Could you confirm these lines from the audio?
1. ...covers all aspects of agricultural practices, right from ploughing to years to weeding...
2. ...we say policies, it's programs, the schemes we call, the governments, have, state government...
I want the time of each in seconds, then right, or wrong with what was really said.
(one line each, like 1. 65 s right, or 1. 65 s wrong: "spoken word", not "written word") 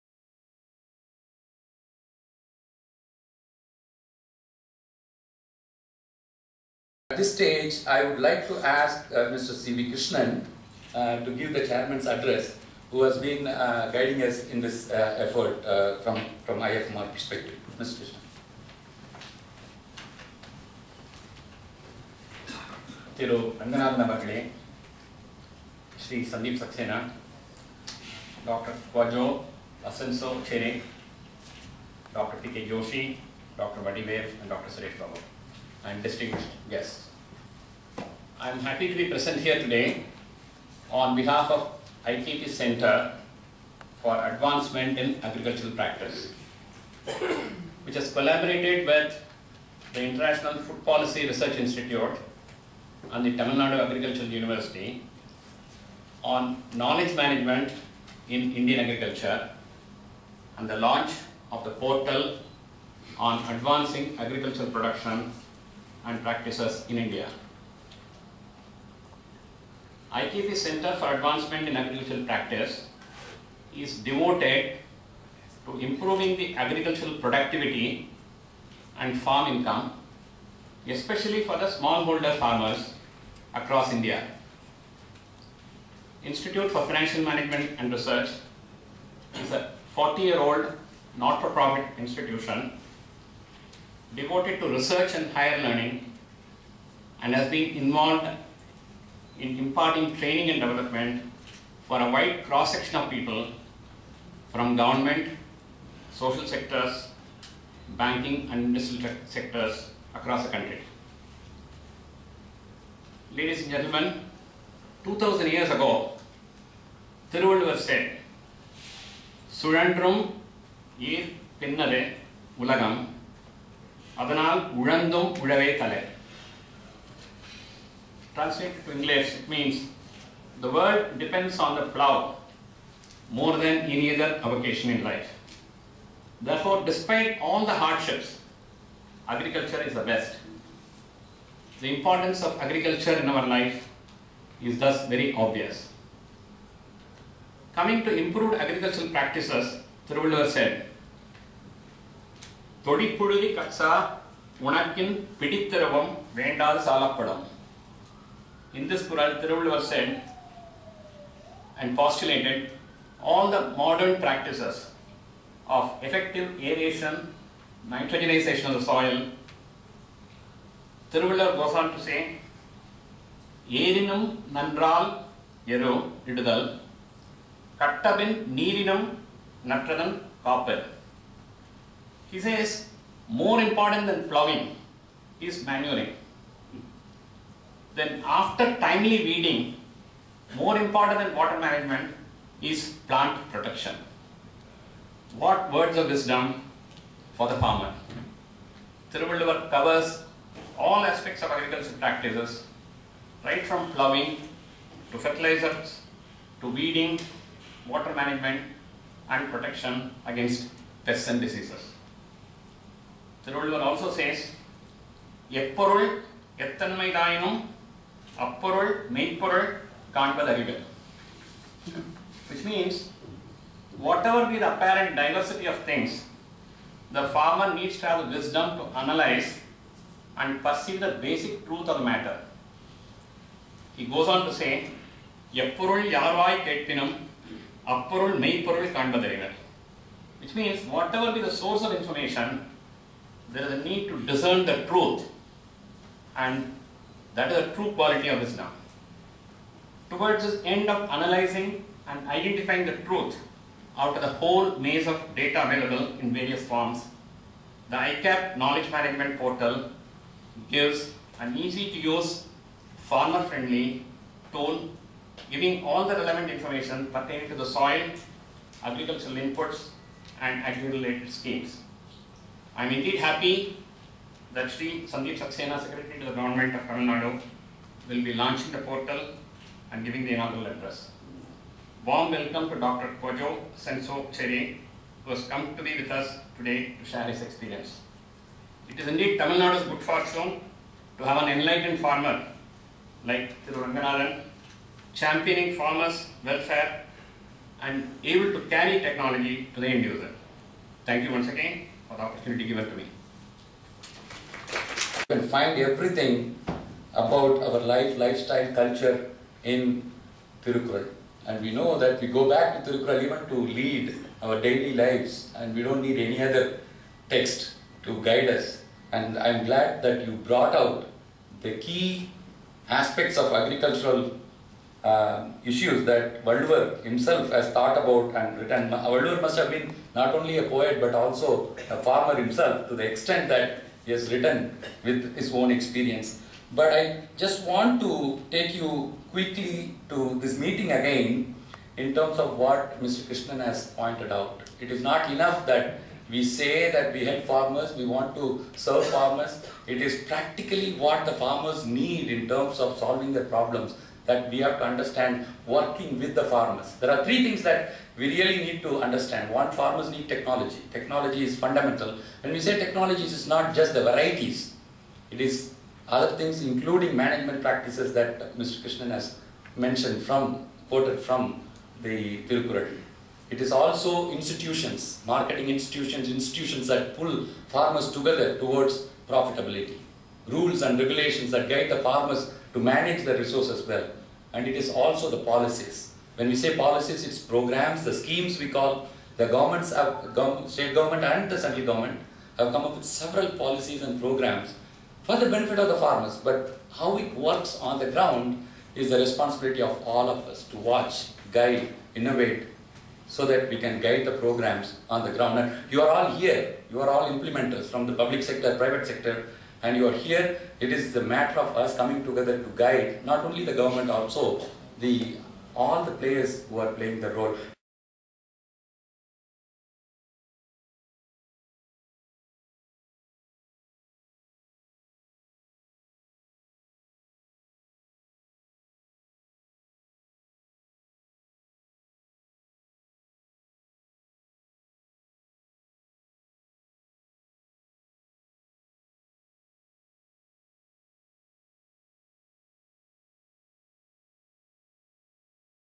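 1. 199 s wrong: "fertilizers", not "years"
2. 386 s right.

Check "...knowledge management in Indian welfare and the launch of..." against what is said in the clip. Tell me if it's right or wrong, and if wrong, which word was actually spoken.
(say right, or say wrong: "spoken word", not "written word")
wrong: "agriculture", not "welfare".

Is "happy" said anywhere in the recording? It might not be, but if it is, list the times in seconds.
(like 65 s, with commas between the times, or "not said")
38 s, 273 s.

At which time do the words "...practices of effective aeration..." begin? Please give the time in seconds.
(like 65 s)
164 s.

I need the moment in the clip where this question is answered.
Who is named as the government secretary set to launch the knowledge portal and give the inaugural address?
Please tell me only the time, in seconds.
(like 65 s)
275 s.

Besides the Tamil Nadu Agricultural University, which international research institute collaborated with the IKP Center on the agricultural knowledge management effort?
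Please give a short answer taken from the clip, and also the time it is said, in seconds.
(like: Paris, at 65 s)
International Food Policy Research Institute, at 50 s.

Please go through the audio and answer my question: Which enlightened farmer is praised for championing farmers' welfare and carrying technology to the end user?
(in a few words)
Thiru Ranganathan.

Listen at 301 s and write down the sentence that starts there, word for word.
Thank you once again for the opportunity given to me.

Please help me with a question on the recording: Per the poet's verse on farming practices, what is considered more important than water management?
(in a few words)
Plant protection.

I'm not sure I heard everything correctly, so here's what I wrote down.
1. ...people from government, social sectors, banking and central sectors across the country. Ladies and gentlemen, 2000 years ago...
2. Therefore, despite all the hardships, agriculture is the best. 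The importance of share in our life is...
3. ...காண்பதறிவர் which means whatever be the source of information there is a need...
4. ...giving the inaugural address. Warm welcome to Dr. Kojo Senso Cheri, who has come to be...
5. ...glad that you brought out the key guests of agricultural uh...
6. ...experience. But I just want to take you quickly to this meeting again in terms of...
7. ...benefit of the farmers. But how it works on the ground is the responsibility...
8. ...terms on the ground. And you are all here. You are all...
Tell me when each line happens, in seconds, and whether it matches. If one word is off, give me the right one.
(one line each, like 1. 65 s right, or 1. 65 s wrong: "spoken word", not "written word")
1. 103 s wrong: "industrial", not "central"
2. 136 s wrong: "agriculture", not "share"
3. 238 s right
4. 280 s right
5. 319 s wrong: "aspects", not "guests"
6. 335 s right
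7. 395 s right
8. 404 s wrong: "programs", not "terms".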